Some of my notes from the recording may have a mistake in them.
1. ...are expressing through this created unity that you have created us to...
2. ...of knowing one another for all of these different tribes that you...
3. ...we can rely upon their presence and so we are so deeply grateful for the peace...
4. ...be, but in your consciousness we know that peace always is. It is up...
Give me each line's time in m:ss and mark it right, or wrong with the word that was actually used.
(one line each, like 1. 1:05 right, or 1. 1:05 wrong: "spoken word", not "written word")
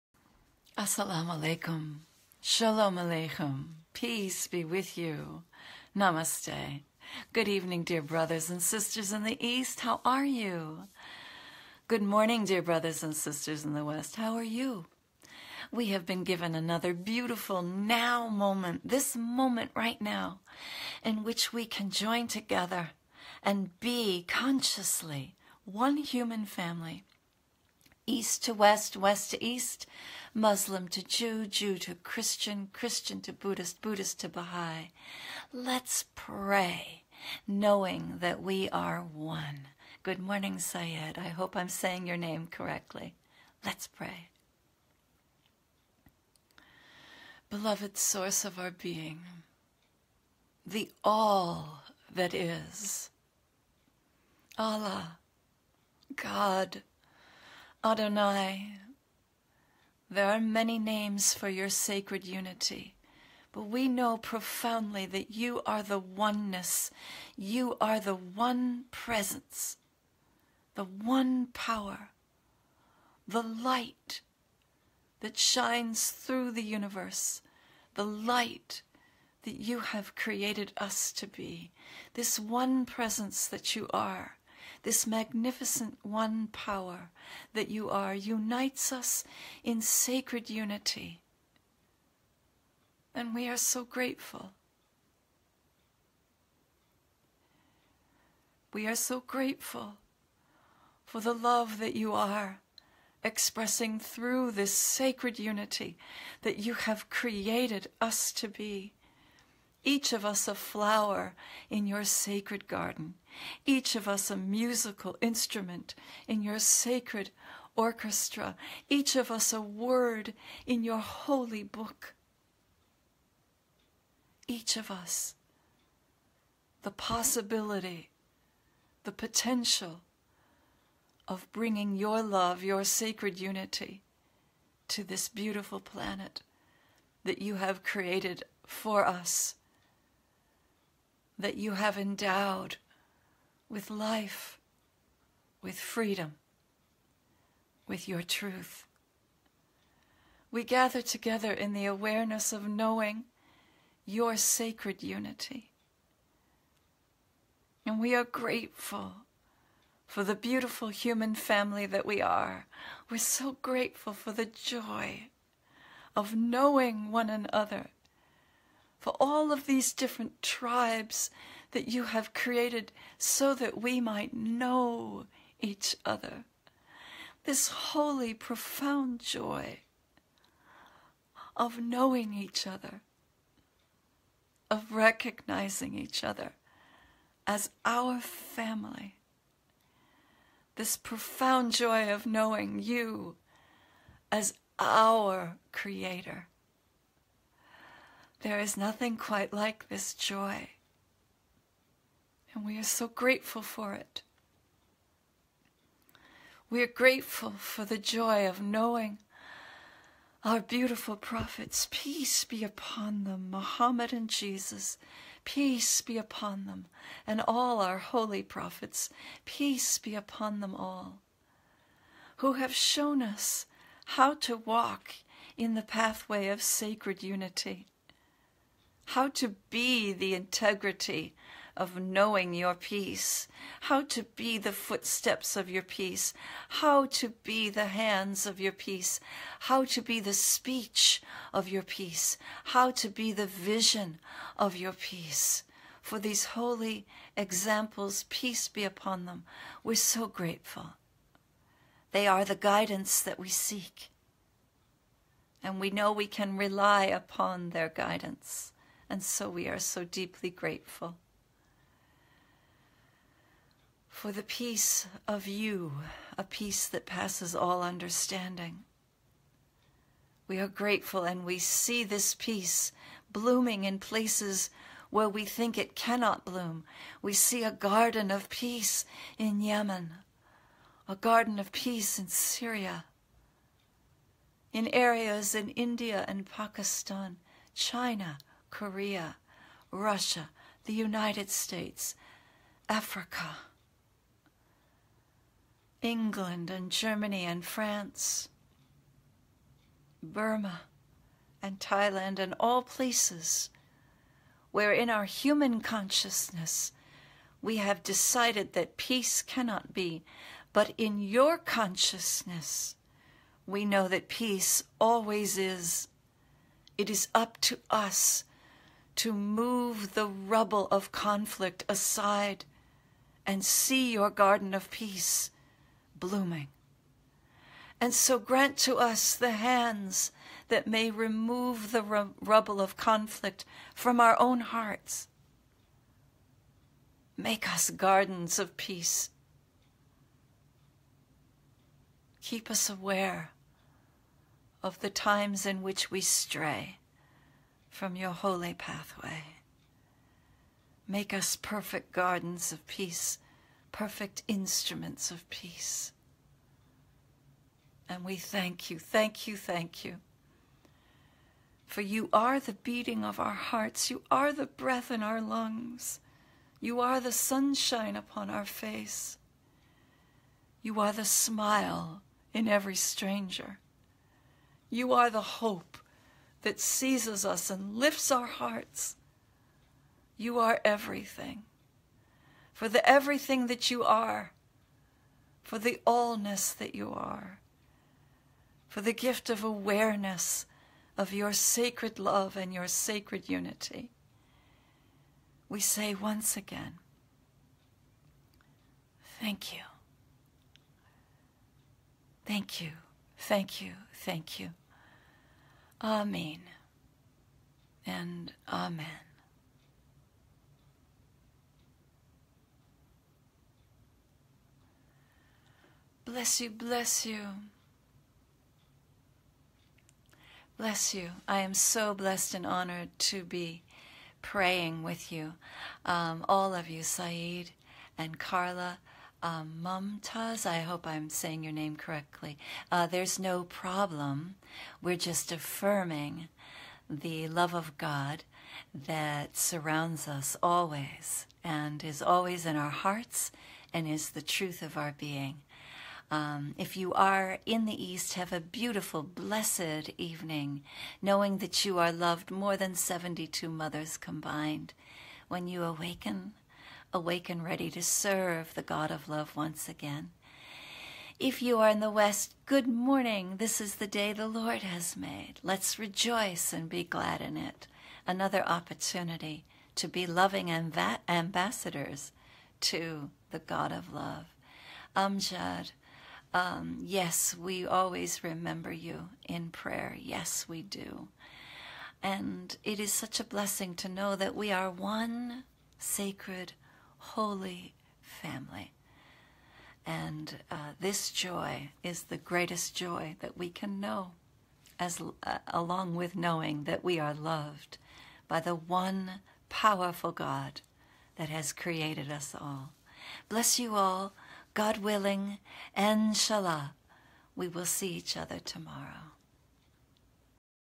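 1. 1:42 wrong: "sacred", not "created"
2. 2:46 right
3. 4:16 wrong: "guidance", not "presence"
4. 5:09 right.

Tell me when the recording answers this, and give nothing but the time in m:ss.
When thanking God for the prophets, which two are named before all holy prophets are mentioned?
3:33.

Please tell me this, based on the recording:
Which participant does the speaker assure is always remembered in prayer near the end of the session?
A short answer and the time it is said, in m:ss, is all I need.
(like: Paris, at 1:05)
Amjad, at 7:55.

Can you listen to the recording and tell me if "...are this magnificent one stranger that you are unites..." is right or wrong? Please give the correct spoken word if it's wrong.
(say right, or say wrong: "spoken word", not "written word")
wrong: "power", not "stranger".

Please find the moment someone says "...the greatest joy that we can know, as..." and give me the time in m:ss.
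8:12.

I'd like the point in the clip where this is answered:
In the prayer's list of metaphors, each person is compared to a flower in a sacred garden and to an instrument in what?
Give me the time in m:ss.
1:56.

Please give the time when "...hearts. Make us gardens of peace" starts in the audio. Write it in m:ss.
5:34.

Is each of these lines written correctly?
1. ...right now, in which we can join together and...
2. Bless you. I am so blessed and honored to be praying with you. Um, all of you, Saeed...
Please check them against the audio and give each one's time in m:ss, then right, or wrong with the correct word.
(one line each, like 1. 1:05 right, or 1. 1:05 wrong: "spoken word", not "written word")
1. 0:19 right
2. 7:00 right.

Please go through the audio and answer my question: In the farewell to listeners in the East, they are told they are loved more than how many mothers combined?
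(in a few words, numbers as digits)
72.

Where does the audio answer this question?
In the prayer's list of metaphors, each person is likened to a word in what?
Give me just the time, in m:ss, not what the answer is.
2:00.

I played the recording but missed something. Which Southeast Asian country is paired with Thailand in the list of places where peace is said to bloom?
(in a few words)
Burma.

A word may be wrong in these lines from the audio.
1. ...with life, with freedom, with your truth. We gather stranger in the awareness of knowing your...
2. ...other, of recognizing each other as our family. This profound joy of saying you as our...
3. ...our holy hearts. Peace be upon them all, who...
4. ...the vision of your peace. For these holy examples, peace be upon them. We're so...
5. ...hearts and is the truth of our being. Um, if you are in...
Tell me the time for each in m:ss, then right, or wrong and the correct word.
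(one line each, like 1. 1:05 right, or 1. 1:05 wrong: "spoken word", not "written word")
1. 2:23 wrong: "together", not "stranger"
2. 3:02 wrong: "knowing", not "saying"
3. 3:37 wrong: "prophets", not "hearts"
4. 4:03 right
5. 7:22 right.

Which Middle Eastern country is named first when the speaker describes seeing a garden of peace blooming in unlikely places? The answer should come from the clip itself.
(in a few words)
Yemen.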